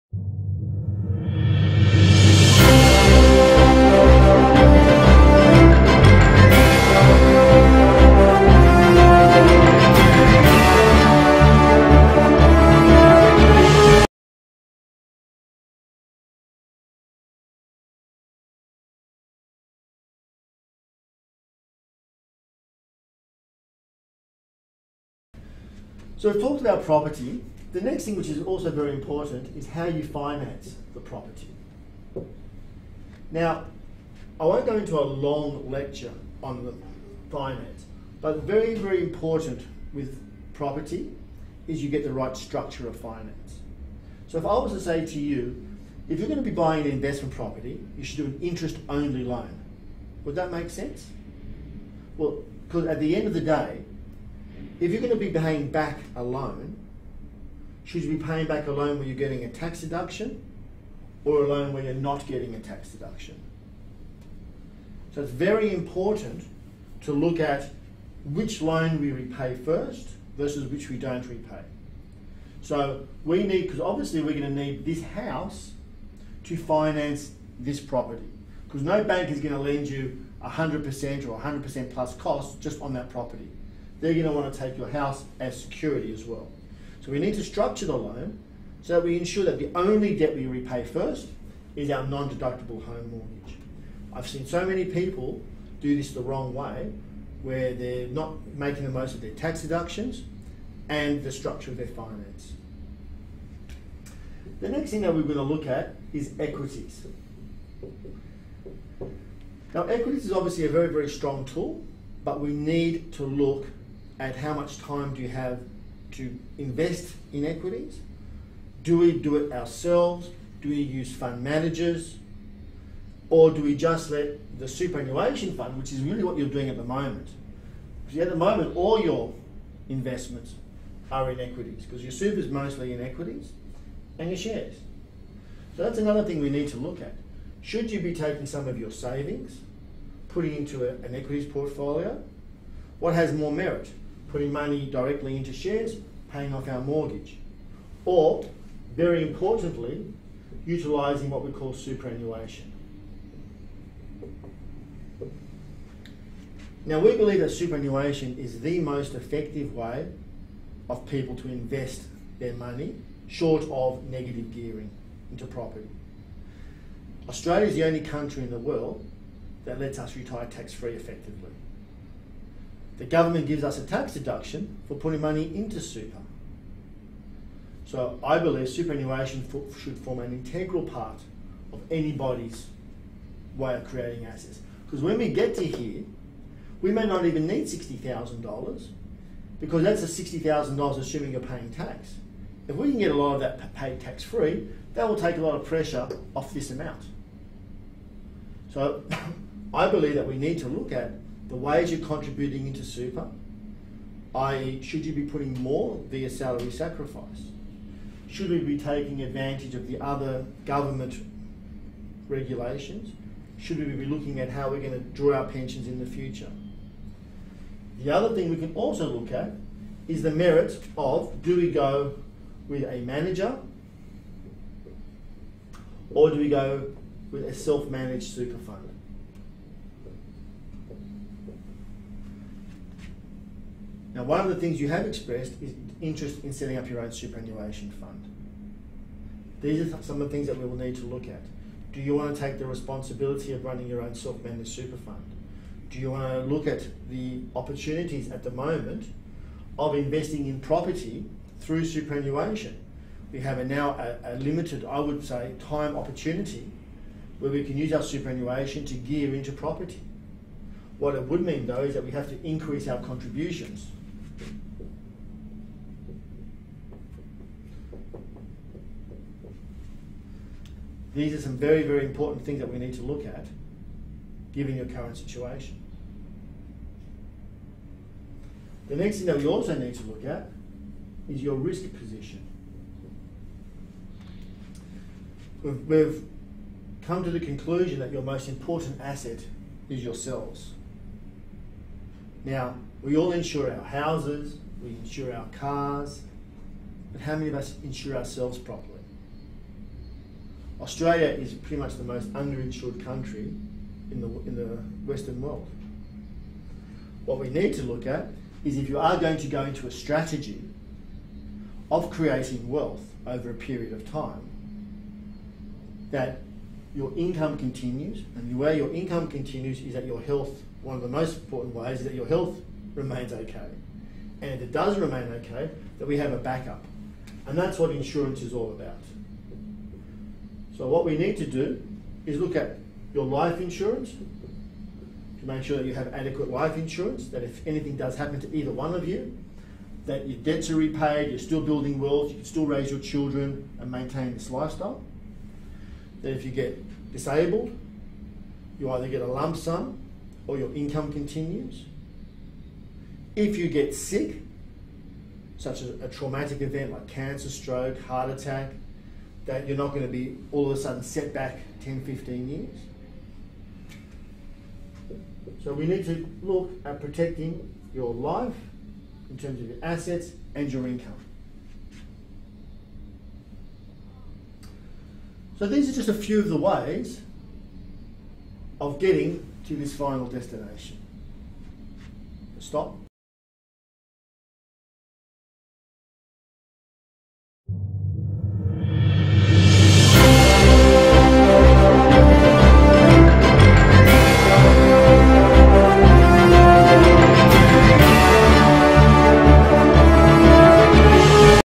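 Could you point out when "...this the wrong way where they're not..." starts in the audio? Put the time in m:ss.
1:35.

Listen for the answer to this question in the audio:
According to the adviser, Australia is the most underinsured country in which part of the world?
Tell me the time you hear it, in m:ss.
5:05.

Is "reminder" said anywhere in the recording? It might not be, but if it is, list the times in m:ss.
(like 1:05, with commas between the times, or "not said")
not said.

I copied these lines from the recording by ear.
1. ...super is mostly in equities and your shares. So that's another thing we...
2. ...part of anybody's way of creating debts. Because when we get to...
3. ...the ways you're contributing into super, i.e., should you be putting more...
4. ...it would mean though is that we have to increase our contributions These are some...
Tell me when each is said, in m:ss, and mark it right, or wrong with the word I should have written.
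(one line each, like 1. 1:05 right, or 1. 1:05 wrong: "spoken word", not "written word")
1. 2:12 right
2. 3:00 wrong: "assets", not "debts"
3. 3:21 right
4. 4:21 right.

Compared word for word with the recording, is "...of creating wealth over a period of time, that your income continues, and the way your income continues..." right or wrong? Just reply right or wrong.
right.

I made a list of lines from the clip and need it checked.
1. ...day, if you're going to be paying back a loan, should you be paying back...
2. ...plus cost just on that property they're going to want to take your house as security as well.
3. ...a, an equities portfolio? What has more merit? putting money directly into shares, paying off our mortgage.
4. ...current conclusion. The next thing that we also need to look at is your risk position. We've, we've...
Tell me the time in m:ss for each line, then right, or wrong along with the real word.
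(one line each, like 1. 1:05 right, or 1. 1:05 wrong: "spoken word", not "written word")
1. 0:53 right
2. 1:21 right
3. 2:20 right
4. 4:34 wrong: "situation", not "conclusion".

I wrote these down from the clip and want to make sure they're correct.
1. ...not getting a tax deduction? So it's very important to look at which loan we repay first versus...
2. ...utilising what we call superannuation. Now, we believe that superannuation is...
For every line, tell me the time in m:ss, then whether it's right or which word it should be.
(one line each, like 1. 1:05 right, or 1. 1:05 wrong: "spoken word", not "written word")
1. 1:01 right
2. 2:30 right.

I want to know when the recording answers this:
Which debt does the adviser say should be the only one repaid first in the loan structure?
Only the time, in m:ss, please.
1:32.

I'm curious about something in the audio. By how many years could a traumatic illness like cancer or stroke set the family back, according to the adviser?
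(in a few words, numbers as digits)
10 to 15 years.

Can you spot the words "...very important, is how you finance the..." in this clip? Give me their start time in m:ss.
0:28.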